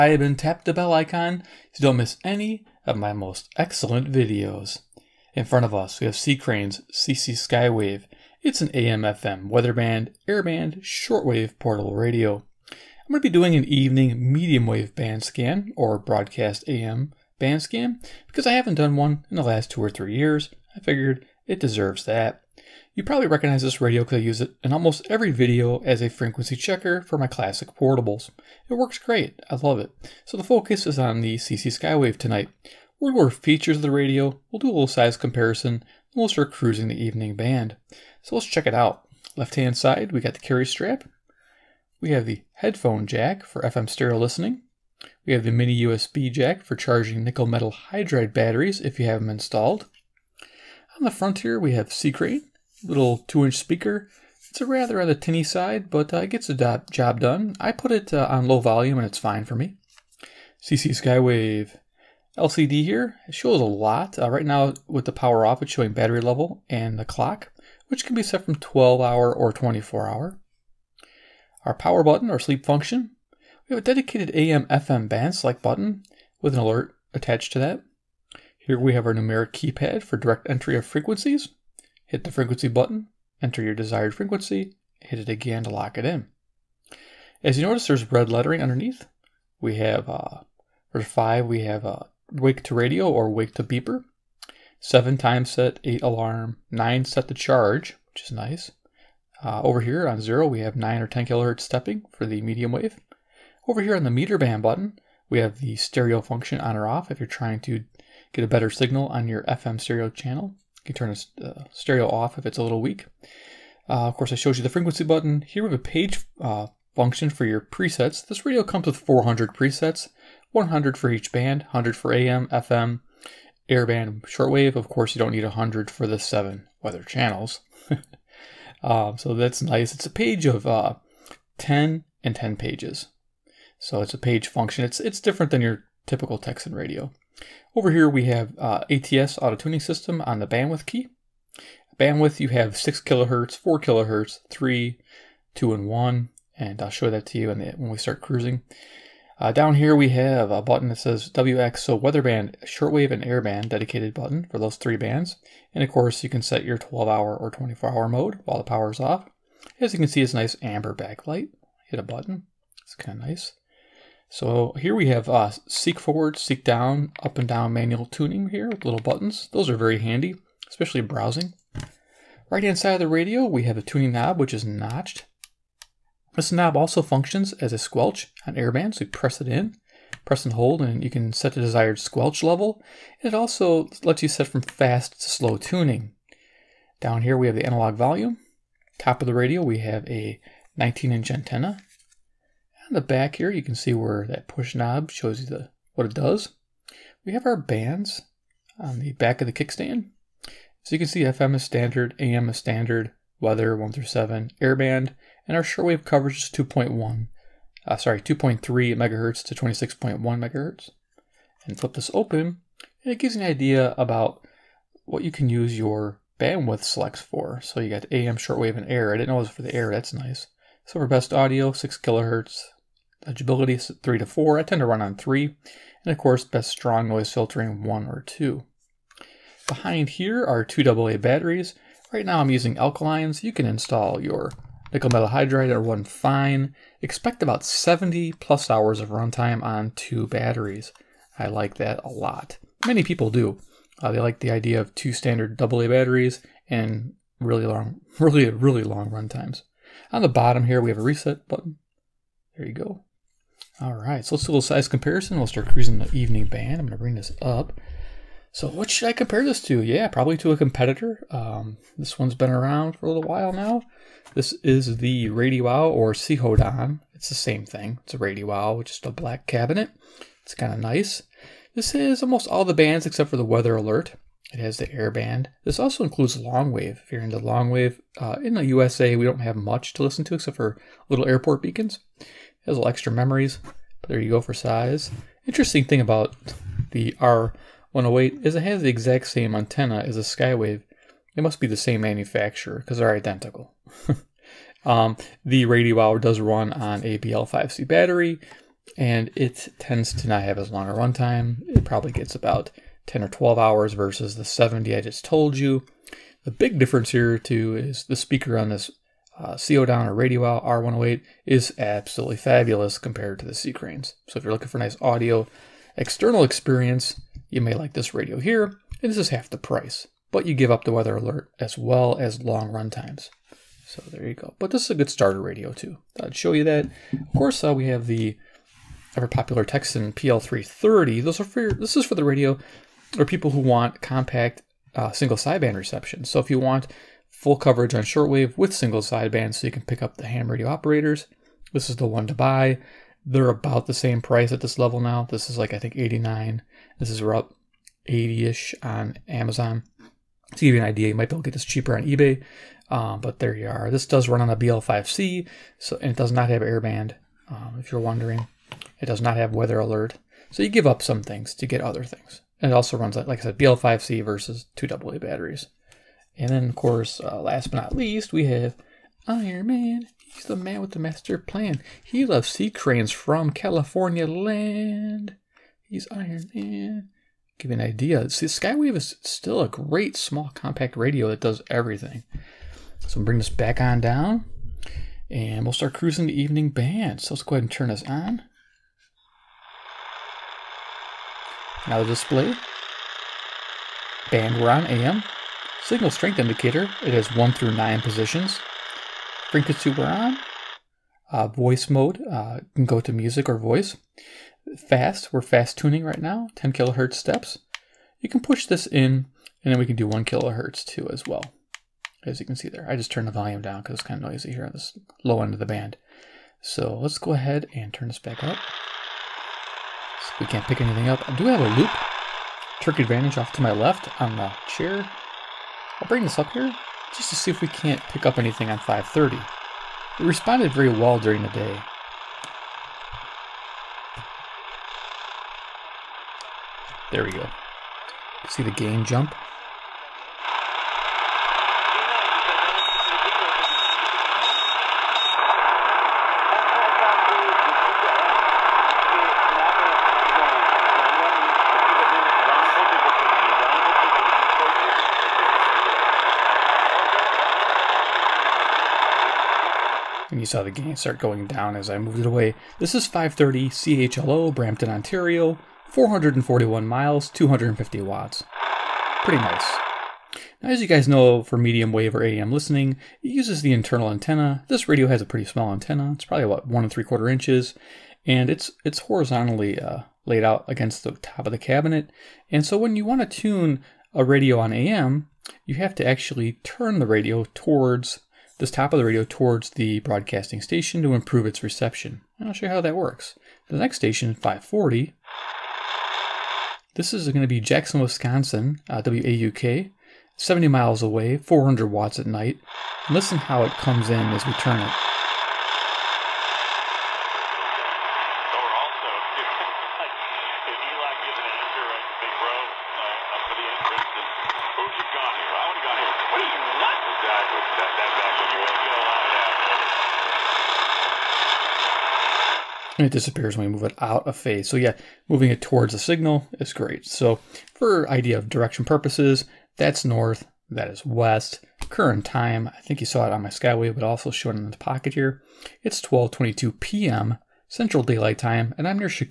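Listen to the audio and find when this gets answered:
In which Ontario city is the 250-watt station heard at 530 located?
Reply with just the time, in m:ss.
7:44.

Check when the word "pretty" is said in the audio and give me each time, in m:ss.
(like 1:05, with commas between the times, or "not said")
7:49, 7:55.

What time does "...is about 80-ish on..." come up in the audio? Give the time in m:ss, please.
5:47.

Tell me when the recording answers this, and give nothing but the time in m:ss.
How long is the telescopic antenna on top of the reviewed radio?
3:10.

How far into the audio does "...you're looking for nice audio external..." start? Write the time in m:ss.
5:14.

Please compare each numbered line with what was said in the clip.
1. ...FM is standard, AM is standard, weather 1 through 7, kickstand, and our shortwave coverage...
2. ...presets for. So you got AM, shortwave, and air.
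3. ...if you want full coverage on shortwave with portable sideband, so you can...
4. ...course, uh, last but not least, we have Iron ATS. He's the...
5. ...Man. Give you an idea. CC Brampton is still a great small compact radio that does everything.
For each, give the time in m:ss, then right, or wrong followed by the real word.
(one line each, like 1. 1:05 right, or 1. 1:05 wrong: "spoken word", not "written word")
1. 3:21 wrong: "airband", not "kickstand"
2. 3:36 wrong: "selects", not "presets"
3. 5:36 wrong: "single", not "portable"
4. 6:06 wrong: "Man", not "ATS"
5. 6:16 wrong: "Skywave", not "Brampton".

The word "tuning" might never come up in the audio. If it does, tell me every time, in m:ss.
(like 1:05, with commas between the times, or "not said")
2:19, 2:48, 2:53, 3:05, 6:45.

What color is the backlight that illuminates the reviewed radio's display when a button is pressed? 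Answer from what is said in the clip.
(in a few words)
amber.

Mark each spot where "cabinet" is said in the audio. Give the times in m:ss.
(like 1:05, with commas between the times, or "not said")
4:29, 8:01.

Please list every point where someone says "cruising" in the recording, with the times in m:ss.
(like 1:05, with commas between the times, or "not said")
0:36, 2:28, 4:15, 6:25.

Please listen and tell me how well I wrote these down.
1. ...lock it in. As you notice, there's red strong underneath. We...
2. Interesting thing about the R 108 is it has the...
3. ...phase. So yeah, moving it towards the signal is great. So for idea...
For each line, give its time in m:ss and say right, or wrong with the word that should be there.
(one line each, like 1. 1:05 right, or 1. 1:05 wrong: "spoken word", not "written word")
1. 1:25 wrong: "lettering", not "strong"
2. 4:45 right
3. 8:44 right.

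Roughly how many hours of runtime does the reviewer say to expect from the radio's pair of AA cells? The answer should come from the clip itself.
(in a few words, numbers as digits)
70 plus hours.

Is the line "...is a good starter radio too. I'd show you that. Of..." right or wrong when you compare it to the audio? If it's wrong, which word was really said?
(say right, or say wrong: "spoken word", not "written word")
right.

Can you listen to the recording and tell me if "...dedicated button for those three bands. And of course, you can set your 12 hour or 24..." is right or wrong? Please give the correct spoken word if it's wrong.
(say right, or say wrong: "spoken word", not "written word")
right.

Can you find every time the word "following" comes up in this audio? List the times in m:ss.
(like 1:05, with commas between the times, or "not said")
not said.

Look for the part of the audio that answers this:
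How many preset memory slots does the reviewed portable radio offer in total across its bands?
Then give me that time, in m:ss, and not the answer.
1:58.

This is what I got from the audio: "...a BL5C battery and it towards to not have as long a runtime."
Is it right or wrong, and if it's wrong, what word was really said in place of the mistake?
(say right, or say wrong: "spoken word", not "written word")
wrong: "tends", not "towards".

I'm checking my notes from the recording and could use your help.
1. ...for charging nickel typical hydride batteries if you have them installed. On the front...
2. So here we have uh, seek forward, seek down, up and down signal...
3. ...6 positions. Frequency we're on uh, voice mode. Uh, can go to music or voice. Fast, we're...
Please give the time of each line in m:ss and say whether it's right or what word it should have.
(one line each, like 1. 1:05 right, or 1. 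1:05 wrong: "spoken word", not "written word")
1. 0:46 wrong: "metal", not "typical"
2. 2:44 wrong: "manual", not "signal"
3. 6:37 wrong: "9", not "6".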